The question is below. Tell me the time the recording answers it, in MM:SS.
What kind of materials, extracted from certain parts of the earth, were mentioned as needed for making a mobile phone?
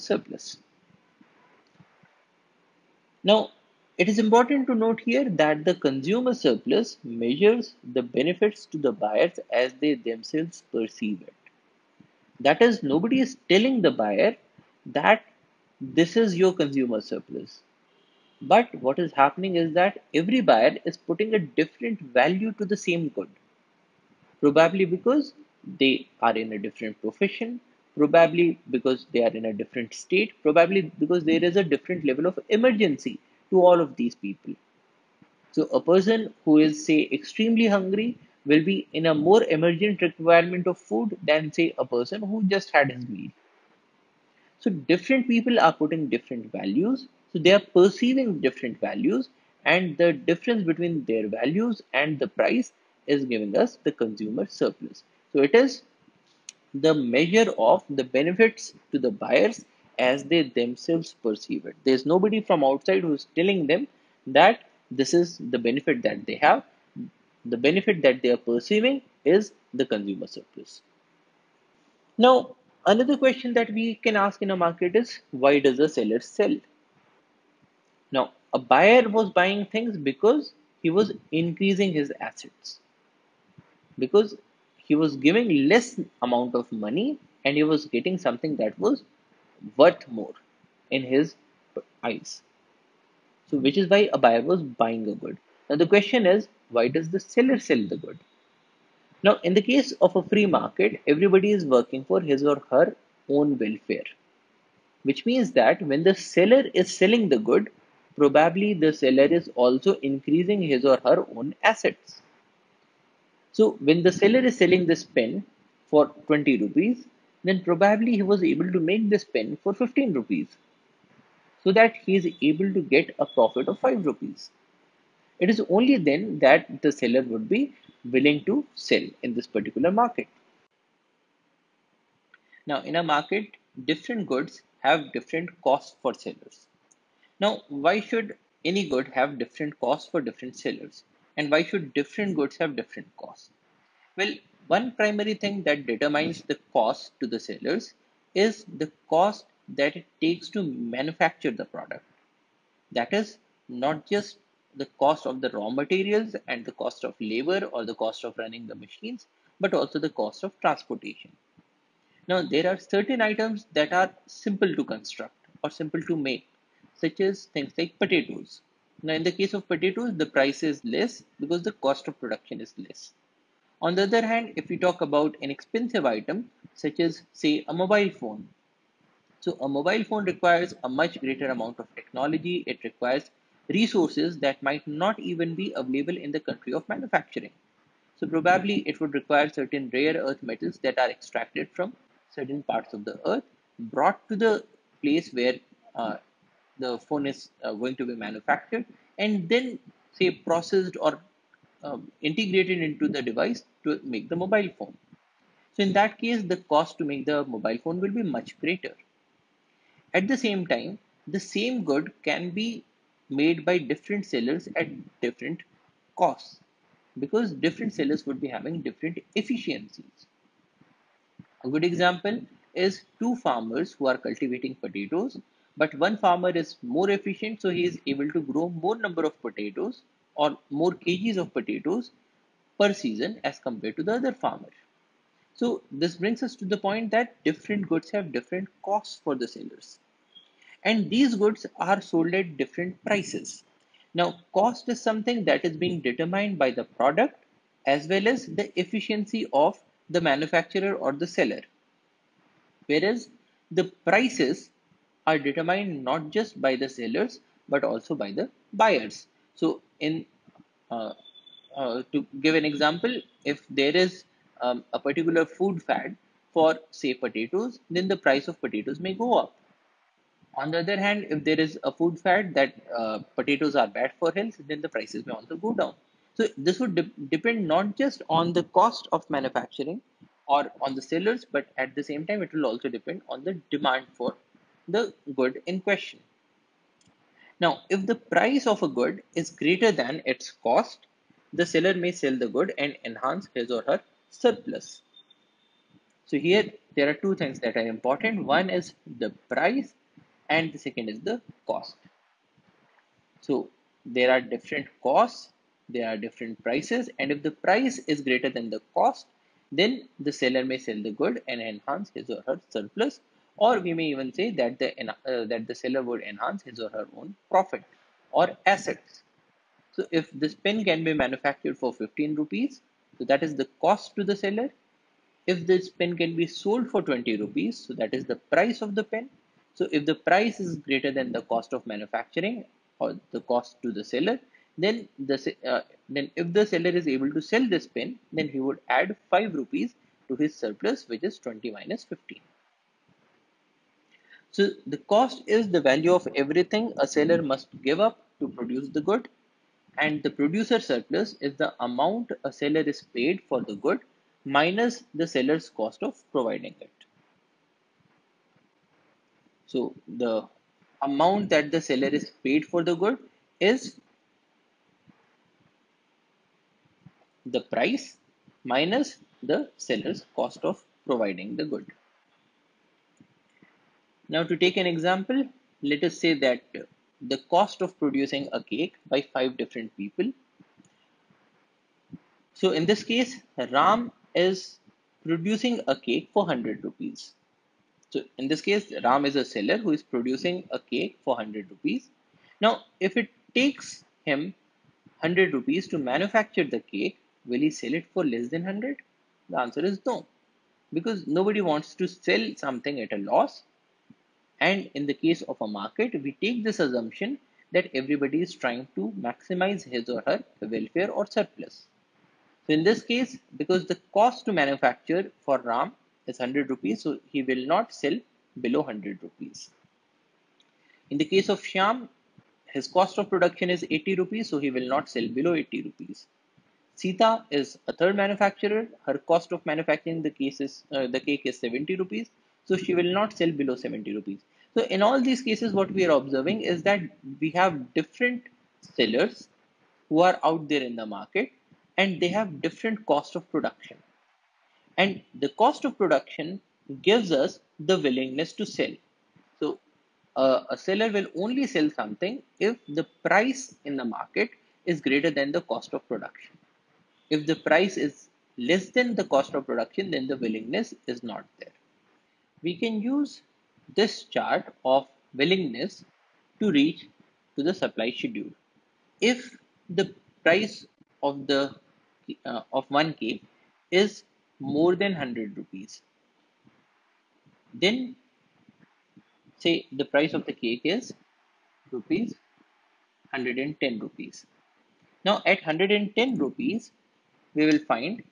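03:09.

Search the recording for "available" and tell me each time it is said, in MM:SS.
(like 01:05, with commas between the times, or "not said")
03:05.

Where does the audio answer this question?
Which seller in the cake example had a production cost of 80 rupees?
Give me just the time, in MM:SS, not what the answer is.
07:01.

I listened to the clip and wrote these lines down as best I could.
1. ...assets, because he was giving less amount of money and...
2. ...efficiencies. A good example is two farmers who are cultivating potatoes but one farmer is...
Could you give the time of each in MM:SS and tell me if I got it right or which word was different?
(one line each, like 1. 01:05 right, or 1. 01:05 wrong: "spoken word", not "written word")
1. 01:22 right
2. 03:39 right.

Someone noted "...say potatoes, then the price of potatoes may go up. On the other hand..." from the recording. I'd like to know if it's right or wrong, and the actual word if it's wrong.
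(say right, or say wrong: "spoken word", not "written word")
right.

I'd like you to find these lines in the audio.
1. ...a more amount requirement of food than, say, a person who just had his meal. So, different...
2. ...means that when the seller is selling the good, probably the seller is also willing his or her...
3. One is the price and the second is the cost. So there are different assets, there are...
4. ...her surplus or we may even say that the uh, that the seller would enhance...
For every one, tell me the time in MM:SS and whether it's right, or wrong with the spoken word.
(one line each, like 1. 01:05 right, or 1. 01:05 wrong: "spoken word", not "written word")
1. 00:39 wrong: "emergent", not "amount"
2. 01:45 wrong: "increasing", not "willing"
3. 04:58 wrong: "costs", not "assets"
4. 05:12 right.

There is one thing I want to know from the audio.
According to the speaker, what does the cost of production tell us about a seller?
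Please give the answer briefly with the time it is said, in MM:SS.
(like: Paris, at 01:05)
willingness to sell, at 07:27.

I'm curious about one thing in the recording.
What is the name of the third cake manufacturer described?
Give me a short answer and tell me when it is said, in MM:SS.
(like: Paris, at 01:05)
Sita, at 07:06.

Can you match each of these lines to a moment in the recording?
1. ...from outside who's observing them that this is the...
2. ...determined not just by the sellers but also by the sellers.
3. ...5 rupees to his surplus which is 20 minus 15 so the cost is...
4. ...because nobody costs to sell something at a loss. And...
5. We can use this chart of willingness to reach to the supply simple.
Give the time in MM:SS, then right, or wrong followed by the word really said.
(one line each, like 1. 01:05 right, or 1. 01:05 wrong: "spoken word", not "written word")
1. 01:02 wrong: "telling", not "observing"
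2. 04:15 wrong: "buyers", not "sellers"
3. 05:39 right
4. 06:40 wrong: "wants", not "costs"
5. 07:42 wrong: "schedule", not "simple".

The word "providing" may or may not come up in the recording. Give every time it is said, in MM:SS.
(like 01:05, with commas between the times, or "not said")
05:56, 06:11.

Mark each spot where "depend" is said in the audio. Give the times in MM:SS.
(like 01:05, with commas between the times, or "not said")
04:37, 04:42.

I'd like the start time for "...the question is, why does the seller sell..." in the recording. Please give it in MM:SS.
01:35.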